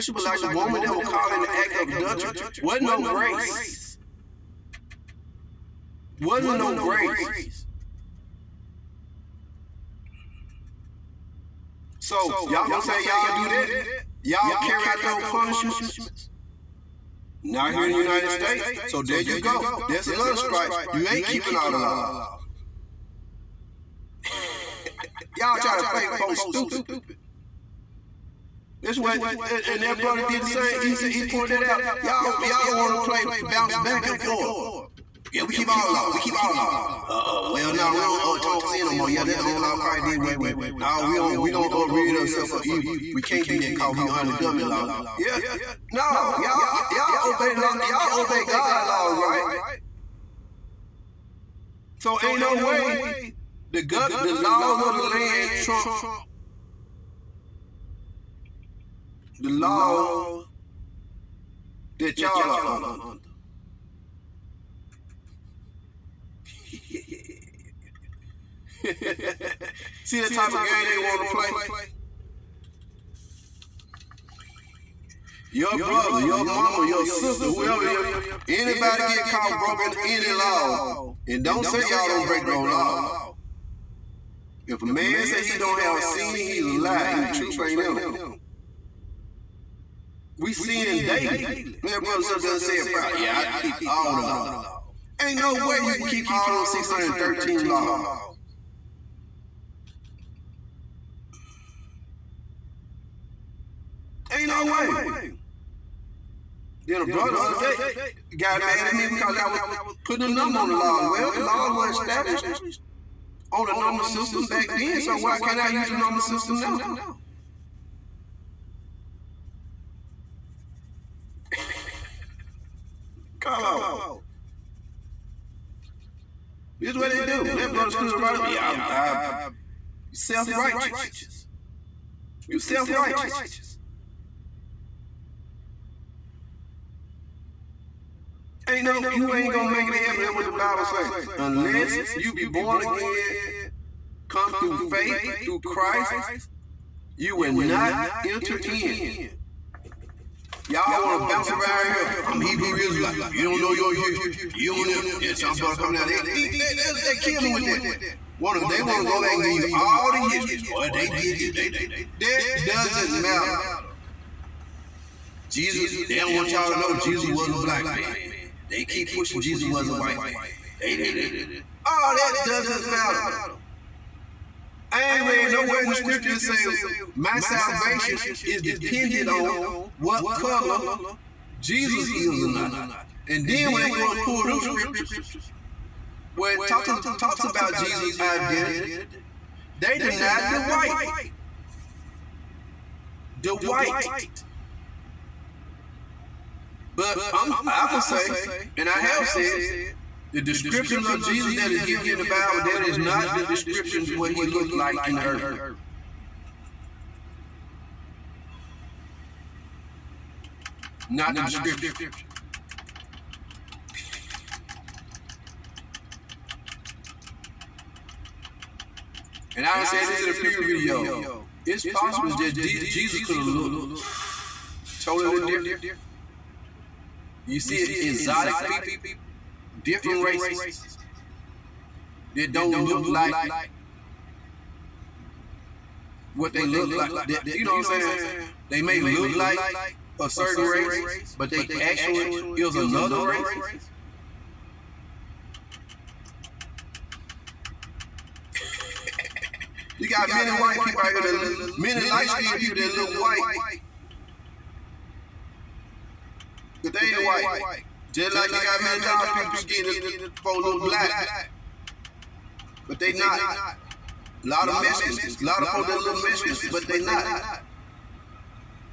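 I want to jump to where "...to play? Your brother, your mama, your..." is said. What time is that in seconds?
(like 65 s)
71 s.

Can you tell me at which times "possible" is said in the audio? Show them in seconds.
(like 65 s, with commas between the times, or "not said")
221 s.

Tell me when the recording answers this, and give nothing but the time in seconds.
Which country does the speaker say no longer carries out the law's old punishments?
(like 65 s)
17 s.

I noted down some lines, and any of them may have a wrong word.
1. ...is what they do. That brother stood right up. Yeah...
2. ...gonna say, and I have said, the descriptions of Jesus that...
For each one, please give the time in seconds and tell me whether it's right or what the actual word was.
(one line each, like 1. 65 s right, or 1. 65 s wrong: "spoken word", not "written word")
1. 126 s right
2. 197 s right.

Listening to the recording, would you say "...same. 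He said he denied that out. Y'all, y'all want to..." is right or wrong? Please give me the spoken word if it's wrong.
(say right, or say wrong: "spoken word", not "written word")
wrong: "pointed", not "denied".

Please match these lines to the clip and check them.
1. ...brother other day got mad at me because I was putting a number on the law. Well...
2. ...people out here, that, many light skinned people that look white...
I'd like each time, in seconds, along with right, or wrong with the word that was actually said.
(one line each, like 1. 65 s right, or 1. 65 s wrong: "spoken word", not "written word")
1. 107 s right
2. 250 s right.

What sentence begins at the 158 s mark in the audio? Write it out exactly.
Wanna, they want to go back and give you all the history.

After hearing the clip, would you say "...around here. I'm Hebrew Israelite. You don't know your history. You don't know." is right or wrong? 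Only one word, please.
right.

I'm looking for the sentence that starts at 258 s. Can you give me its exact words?
Just like you got million dollar people skinning for a little black.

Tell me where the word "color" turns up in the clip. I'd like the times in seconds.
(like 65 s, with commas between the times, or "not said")
180 s.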